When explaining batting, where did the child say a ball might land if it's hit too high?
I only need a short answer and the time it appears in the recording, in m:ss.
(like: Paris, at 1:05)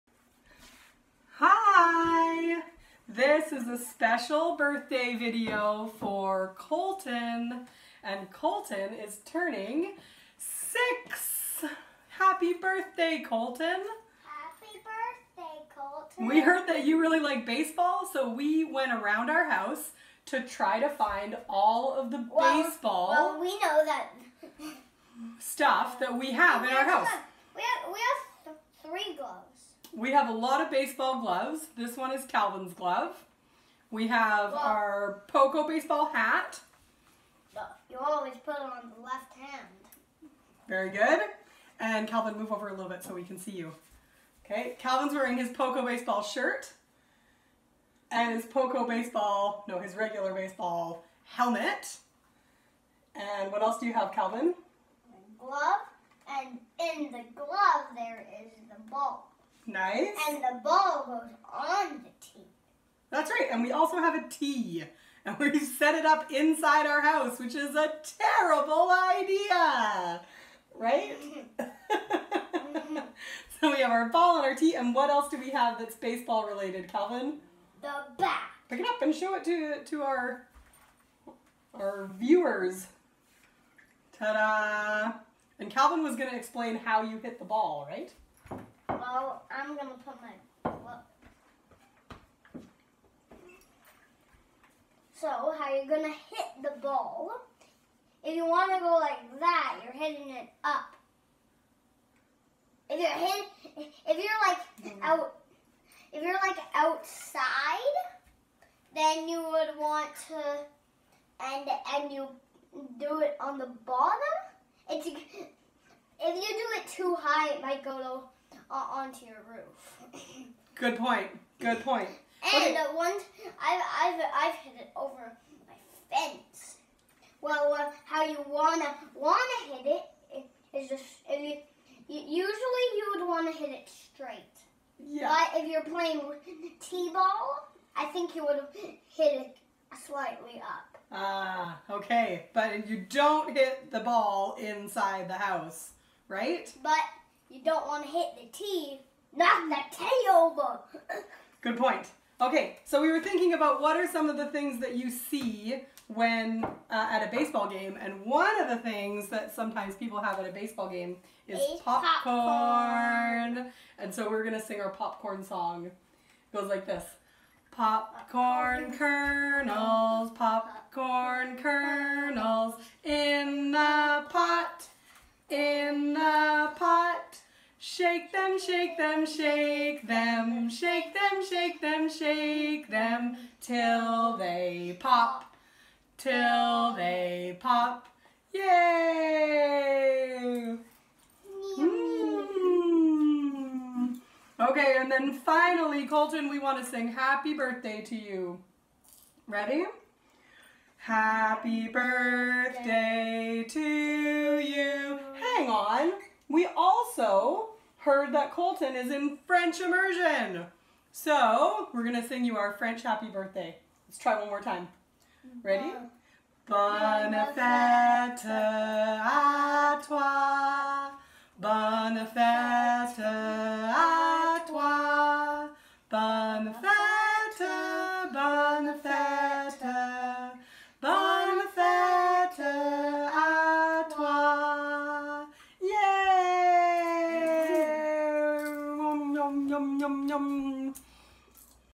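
onto your roof, at 1:59.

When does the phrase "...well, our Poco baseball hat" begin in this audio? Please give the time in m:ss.
0:34.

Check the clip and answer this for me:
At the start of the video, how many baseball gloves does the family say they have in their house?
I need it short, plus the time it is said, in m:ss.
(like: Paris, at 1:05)
3, at 0:28.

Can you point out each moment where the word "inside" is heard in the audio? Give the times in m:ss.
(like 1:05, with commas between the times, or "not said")
1:06, 2:24.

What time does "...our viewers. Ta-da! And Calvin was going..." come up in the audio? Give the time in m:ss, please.
1:21.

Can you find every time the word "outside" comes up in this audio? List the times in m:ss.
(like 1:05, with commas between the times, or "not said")
1:46.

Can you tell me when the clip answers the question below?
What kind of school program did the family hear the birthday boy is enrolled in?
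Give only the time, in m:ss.
3:29.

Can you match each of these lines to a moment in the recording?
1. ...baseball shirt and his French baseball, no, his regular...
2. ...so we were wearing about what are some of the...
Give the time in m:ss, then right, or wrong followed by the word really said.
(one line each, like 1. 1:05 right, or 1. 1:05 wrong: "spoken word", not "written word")
1. 0:45 wrong: "Poco", not "French"
2. 2:32 wrong: "thinking", not "wearing".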